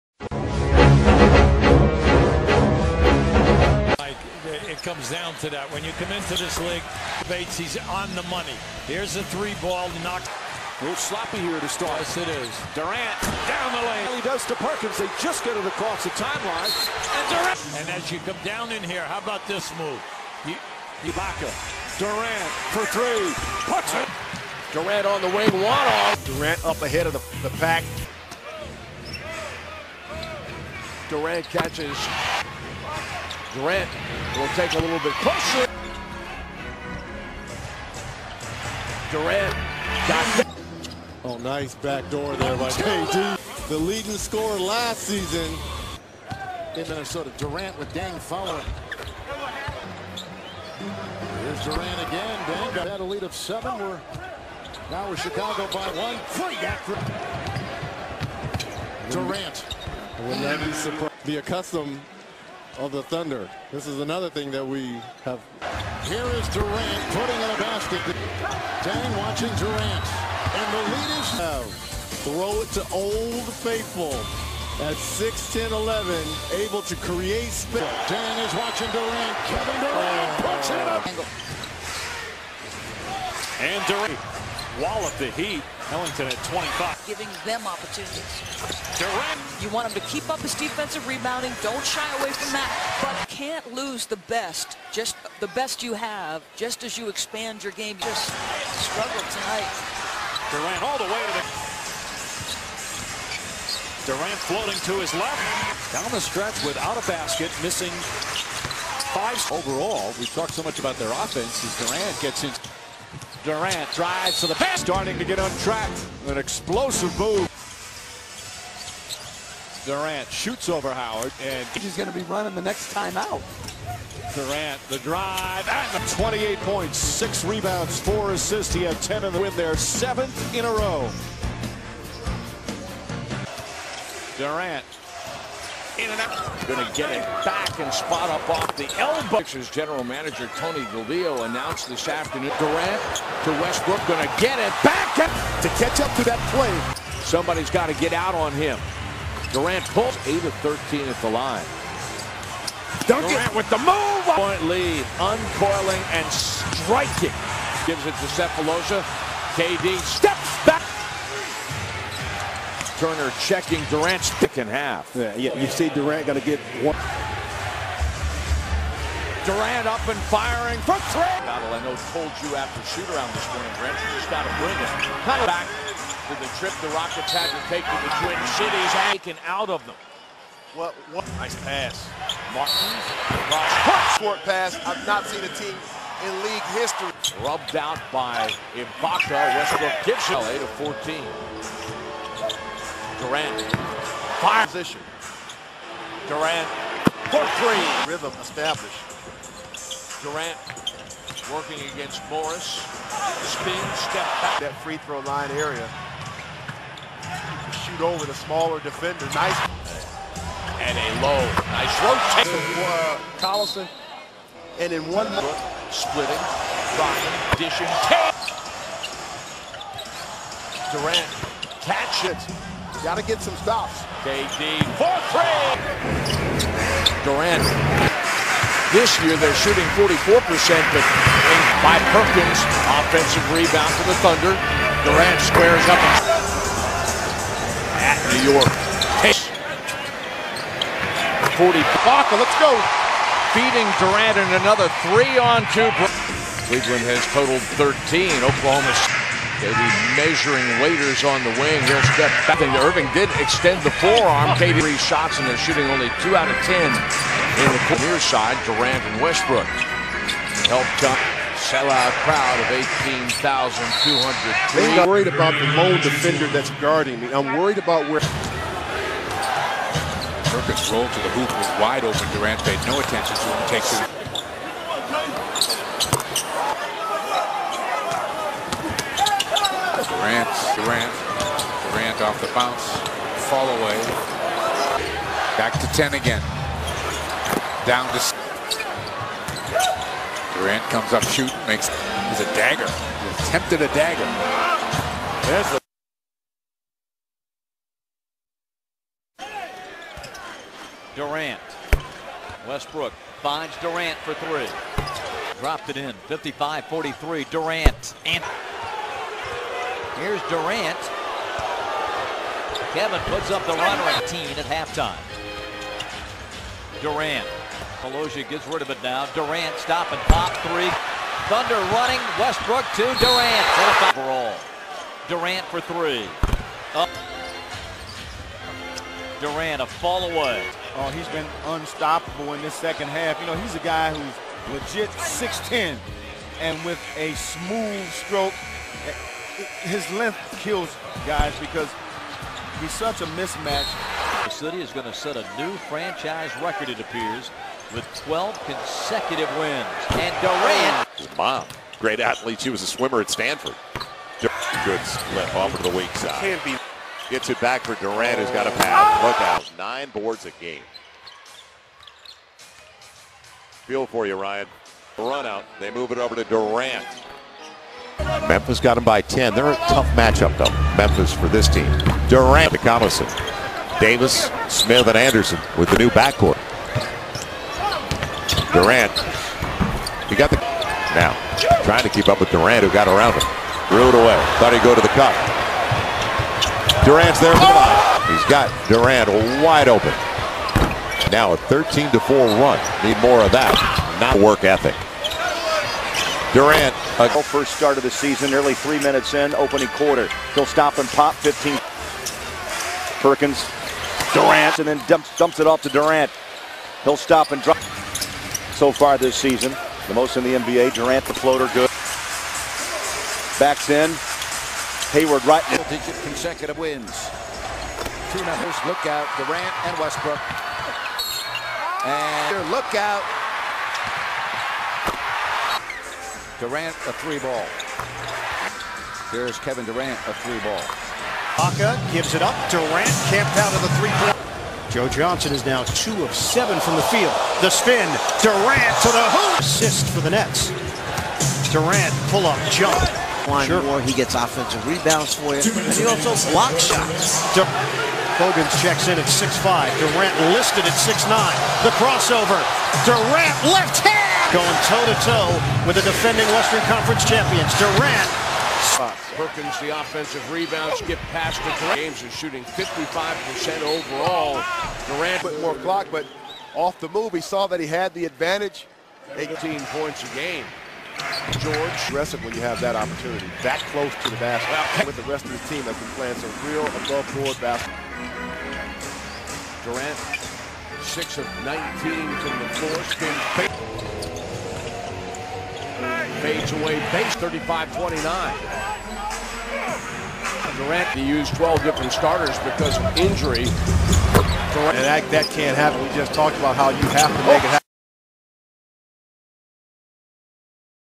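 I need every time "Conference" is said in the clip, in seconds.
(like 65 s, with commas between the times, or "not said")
456 s.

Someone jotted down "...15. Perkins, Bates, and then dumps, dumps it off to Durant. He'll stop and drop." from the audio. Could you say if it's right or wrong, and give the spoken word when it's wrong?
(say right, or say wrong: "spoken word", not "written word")
wrong: "Durant", not "Bates".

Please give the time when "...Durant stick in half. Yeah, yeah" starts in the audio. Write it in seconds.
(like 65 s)
163 s.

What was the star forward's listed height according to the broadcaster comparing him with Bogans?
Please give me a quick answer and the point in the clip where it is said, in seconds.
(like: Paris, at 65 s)
6'9, at 450 s.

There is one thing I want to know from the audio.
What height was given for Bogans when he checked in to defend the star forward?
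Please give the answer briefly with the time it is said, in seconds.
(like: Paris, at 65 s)
6'5, at 449 s.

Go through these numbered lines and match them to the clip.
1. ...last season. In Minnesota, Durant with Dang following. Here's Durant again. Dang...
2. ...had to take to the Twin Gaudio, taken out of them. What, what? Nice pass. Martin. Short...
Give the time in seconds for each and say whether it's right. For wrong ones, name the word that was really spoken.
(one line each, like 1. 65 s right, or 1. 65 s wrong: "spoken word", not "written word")
1. 44 s right
2. 177 s wrong: "Cities", not "Gaudio".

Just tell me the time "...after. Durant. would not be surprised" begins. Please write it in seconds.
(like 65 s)
56 s.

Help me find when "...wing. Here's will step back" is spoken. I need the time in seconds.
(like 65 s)
251 s.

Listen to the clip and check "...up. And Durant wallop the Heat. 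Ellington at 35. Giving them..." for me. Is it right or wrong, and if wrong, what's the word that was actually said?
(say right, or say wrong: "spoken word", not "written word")
wrong: "25", not "35".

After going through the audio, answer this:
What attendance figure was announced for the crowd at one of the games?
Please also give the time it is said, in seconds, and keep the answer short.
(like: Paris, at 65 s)
18,200, at 263 s.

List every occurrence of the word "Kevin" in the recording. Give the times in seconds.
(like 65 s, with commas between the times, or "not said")
79 s, 312 s, 429 s.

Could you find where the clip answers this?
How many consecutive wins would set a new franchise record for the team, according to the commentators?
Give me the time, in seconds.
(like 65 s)
348 s.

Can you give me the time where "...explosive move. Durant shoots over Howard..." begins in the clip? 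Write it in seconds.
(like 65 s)
116 s.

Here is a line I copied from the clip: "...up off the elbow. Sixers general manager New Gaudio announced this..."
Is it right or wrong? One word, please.
wrong.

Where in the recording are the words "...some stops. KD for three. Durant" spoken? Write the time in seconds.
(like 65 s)
223 s.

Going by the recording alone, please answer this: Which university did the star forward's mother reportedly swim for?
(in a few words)
Stanford.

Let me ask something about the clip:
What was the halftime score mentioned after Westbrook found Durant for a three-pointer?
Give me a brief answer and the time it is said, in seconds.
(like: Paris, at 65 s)
55-43, at 306 s.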